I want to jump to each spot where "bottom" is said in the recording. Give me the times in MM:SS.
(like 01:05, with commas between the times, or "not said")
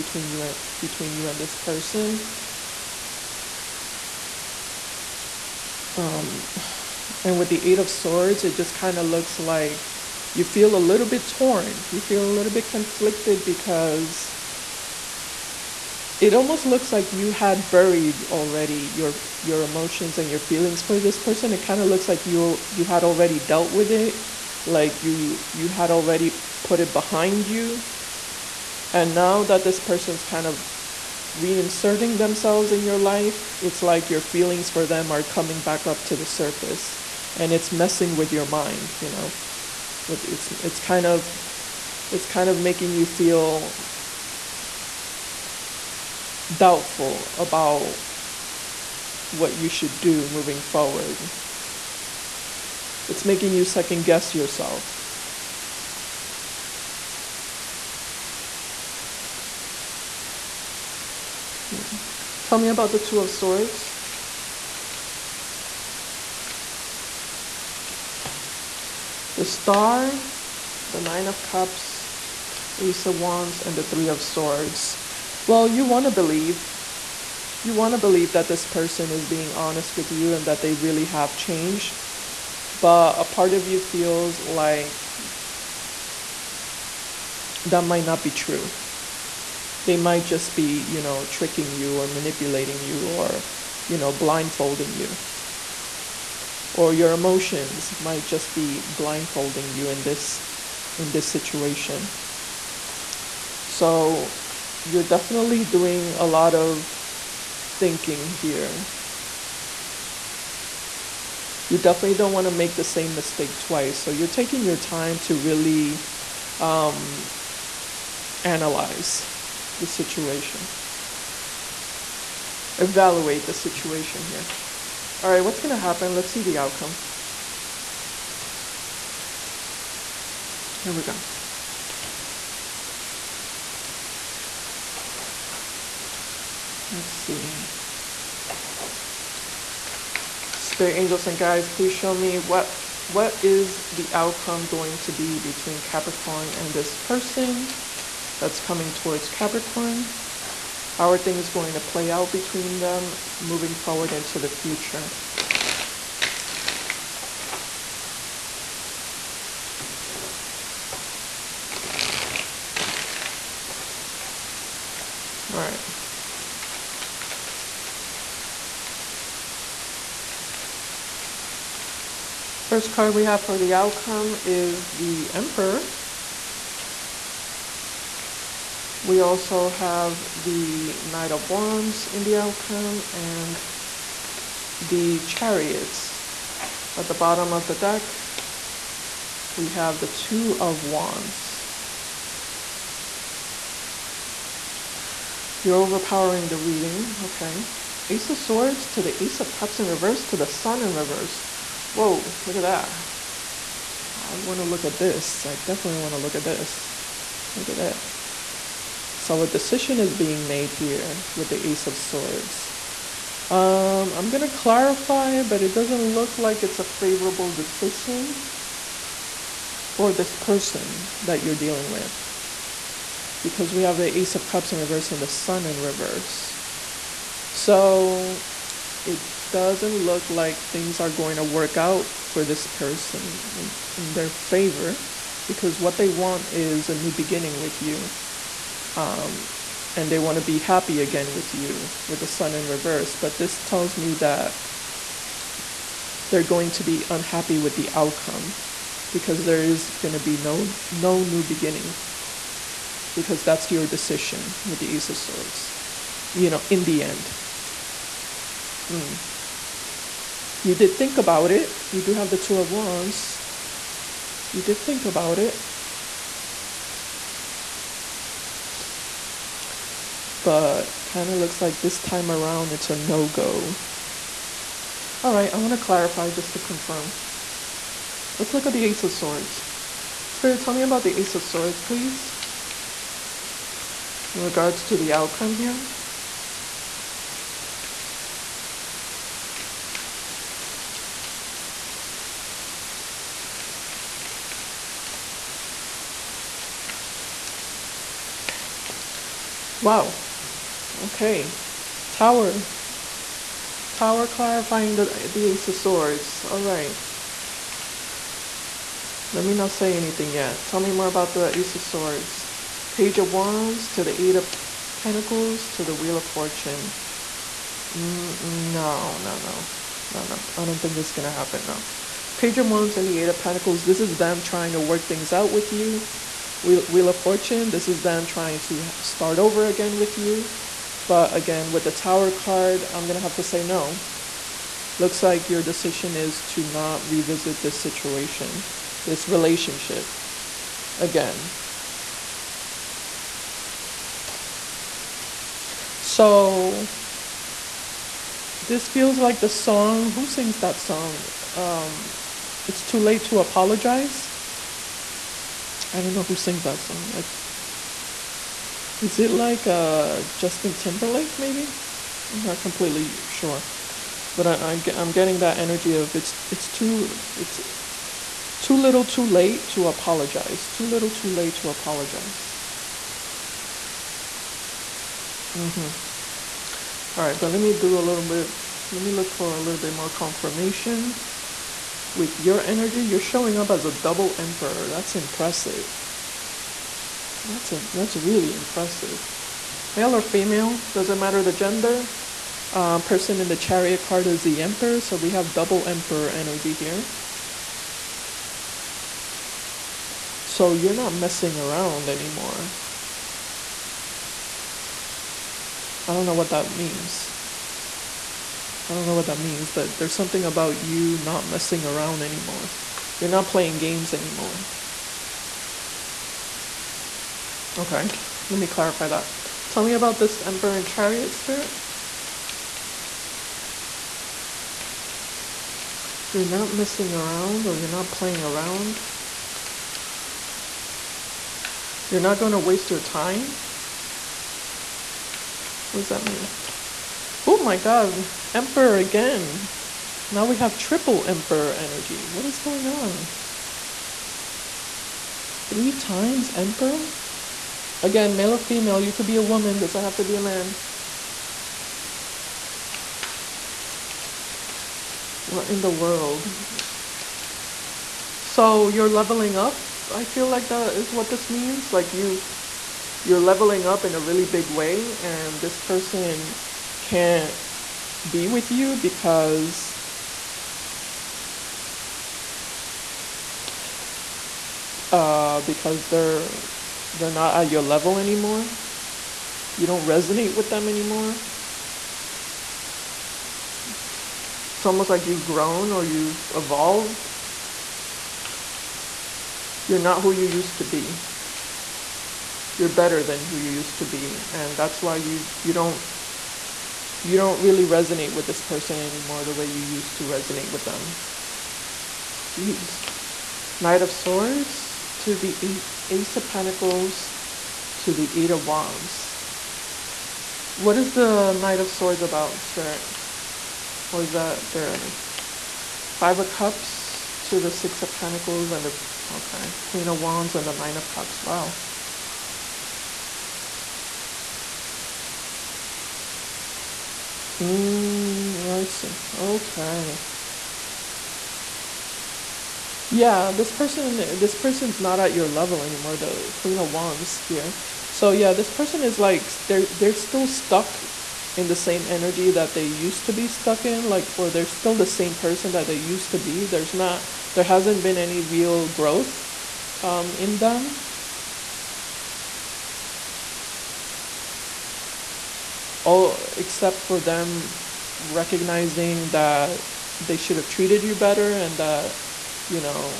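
03:07.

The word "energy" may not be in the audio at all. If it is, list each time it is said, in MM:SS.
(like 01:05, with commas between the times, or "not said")
06:05, 06:22, 06:36, 07:21, 08:34, 09:02.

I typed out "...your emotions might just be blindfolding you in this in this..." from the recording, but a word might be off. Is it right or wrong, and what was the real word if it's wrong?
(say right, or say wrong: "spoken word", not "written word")
right.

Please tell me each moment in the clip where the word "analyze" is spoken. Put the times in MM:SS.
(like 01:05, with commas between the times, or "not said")
01:58.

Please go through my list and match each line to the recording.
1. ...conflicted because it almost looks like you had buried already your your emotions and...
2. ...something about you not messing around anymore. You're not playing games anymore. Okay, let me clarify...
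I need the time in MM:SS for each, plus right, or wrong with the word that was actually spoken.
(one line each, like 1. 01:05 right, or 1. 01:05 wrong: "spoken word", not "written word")
1. 00:12 right
2. 06:50 right.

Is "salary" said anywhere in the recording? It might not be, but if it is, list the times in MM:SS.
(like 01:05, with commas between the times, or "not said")
not said.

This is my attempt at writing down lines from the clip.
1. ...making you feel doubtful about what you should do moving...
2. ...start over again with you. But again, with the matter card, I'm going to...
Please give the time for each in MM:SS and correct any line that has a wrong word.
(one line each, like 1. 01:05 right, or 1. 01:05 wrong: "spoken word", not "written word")
1. 00:42 right
2. 05:29 wrong: "tower", not "matter".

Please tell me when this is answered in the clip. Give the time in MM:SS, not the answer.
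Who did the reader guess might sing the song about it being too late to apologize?
06:00.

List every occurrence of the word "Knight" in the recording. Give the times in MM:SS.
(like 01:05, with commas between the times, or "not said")
03:01, 08:23, 08:31.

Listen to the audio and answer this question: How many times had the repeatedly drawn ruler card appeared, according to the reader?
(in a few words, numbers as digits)
3.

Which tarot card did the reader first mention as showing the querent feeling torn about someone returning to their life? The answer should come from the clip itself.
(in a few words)
Eight of Swords.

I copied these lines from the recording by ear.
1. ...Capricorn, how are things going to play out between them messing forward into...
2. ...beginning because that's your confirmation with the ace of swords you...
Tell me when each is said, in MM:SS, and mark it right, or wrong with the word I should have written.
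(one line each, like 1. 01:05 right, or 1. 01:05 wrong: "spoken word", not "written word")
1. 02:29 wrong: "moving", not "messing"
2. 04:11 wrong: "decision", not "confirmation".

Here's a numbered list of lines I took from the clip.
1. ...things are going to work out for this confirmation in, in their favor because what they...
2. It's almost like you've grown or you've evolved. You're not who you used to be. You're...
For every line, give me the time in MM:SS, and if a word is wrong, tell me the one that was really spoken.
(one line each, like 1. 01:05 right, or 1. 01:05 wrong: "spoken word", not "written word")
1. 03:50 wrong: "person", not "confirmation"
2. 08:04 right.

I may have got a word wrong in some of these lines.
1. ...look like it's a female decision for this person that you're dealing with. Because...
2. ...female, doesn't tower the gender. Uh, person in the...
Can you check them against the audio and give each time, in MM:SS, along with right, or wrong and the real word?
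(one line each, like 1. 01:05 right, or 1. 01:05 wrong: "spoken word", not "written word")
1. 03:36 wrong: "favorable", not "female"
2. 06:30 wrong: "matter", not "tower".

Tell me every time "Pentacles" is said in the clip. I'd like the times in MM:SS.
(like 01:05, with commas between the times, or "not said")
05:14, 05:23, 08:26, 08:38.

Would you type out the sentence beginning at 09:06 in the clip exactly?
There's not there hasn't been any real growth um in them.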